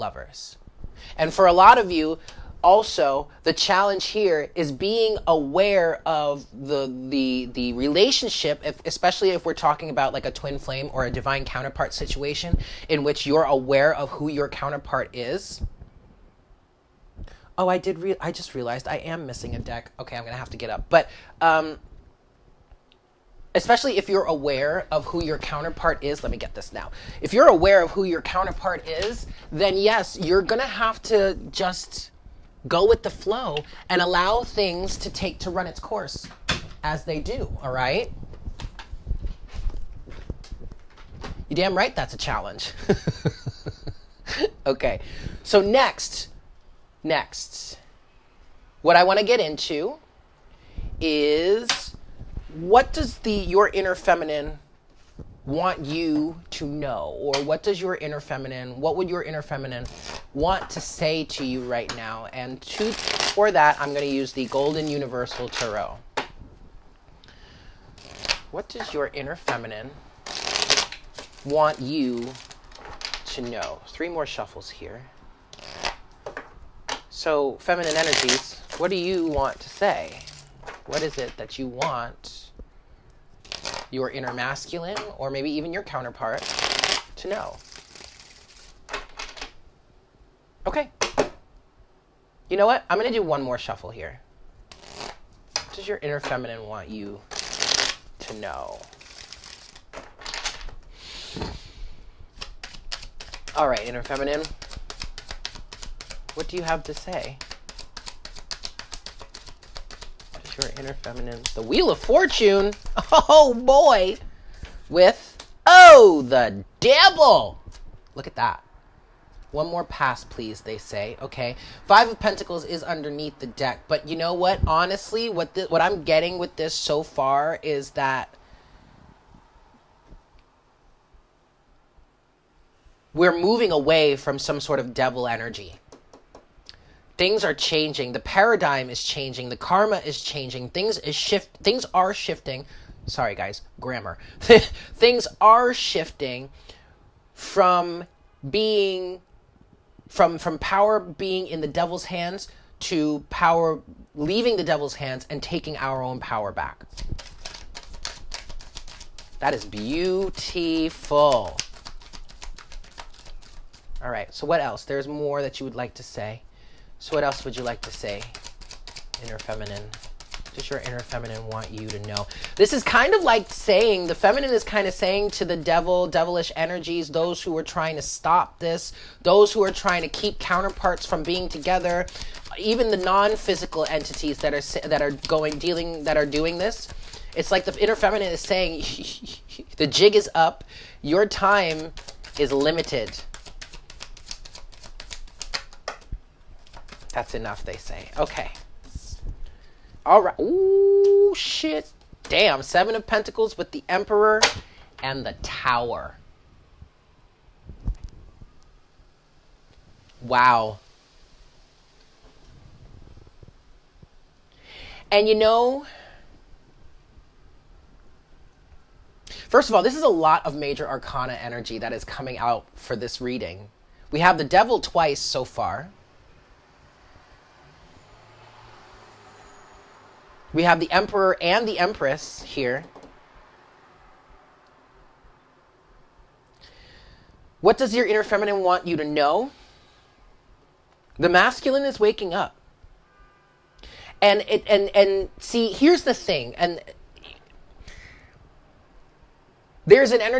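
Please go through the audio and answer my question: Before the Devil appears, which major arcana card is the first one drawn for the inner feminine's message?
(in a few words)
The Wheel of Fortune.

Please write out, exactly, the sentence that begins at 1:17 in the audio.
So, feminine energies, what do you want to say?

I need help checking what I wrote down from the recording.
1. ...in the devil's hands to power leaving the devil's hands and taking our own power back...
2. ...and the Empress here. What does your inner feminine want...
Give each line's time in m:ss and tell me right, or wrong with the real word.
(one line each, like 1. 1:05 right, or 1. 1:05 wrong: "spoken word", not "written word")
1. 2:31 right
2. 3:51 right.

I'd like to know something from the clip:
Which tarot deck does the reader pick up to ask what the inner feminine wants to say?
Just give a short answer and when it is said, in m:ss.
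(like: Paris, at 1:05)
Golden Universal Tarot, at 1:04.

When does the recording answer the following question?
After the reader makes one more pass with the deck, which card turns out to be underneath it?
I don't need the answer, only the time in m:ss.
2:01.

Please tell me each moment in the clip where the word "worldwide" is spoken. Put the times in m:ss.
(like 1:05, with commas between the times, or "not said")
not said.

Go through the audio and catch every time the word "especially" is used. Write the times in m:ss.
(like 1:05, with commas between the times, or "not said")
0:08, 0:23.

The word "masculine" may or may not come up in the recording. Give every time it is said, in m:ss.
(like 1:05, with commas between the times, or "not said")
1:24, 4:01.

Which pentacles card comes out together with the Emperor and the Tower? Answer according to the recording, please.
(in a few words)
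Seven of Pentacles.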